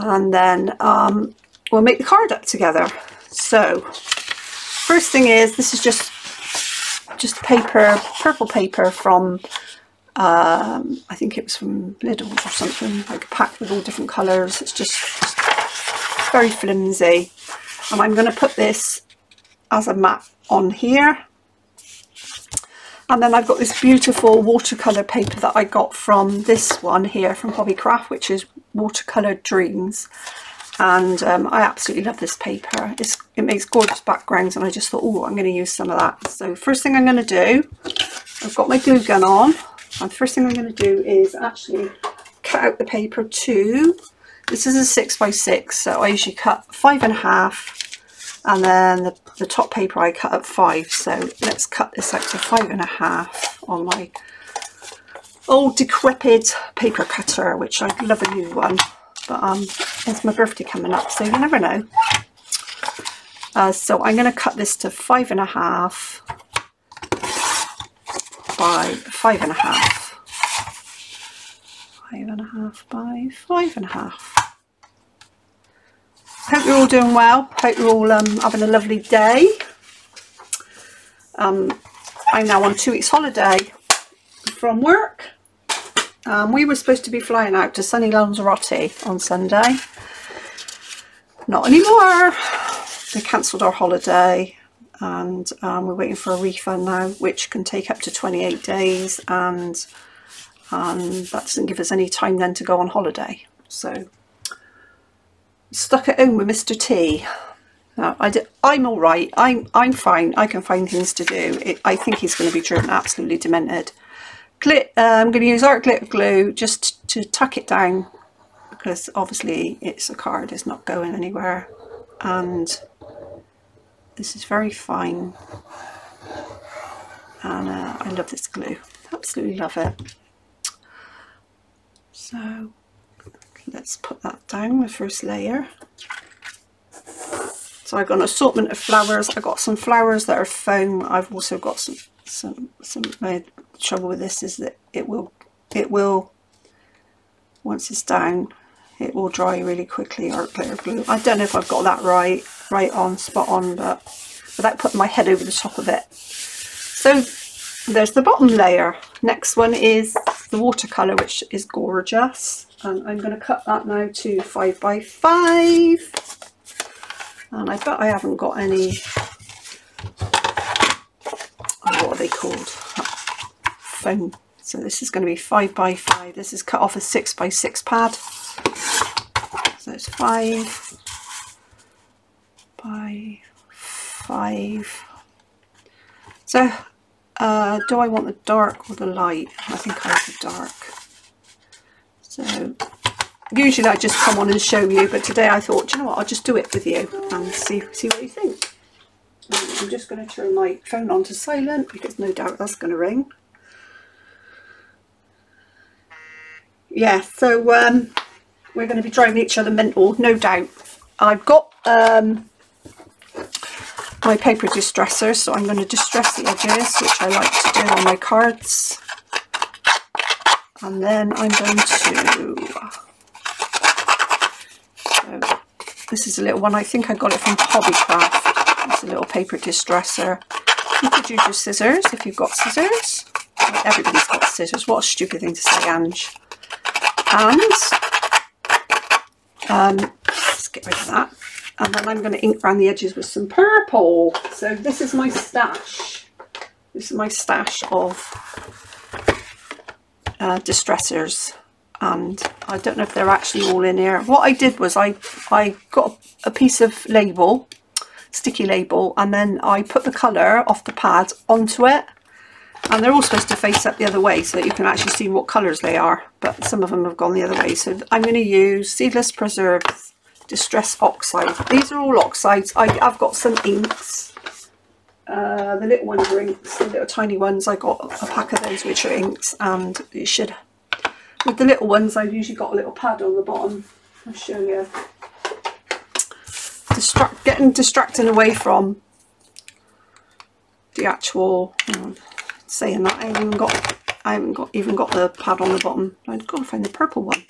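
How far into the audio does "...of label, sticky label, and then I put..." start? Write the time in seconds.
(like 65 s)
256 s.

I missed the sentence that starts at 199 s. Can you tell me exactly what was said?
I'm just going to turn my phone on to silent because no doubt that's going to ring.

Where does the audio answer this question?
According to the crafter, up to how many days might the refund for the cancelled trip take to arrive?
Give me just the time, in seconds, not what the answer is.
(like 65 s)
98 s.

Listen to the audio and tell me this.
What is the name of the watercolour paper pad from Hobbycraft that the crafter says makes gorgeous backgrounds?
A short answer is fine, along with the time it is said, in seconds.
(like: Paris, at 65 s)
Watercolour Dreams, at 28 s.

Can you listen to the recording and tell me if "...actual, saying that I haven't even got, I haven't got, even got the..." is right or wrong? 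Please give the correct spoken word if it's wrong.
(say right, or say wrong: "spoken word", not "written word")
right.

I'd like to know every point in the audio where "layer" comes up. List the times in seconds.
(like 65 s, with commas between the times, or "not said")
135 s, 158 s.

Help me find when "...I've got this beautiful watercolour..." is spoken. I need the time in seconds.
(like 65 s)
23 s.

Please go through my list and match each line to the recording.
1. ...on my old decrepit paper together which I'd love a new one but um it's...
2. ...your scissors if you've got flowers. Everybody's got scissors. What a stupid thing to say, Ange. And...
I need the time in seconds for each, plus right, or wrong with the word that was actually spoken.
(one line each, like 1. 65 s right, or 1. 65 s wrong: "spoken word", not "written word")
1. 53 s wrong: "cutter", not "together"
2. 231 s wrong: "scissors", not "flowers".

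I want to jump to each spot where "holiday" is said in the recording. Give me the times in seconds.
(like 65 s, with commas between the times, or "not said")
83 s, 93 s, 102 s.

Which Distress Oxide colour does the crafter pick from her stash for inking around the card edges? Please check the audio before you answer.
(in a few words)
Seedless Preserve.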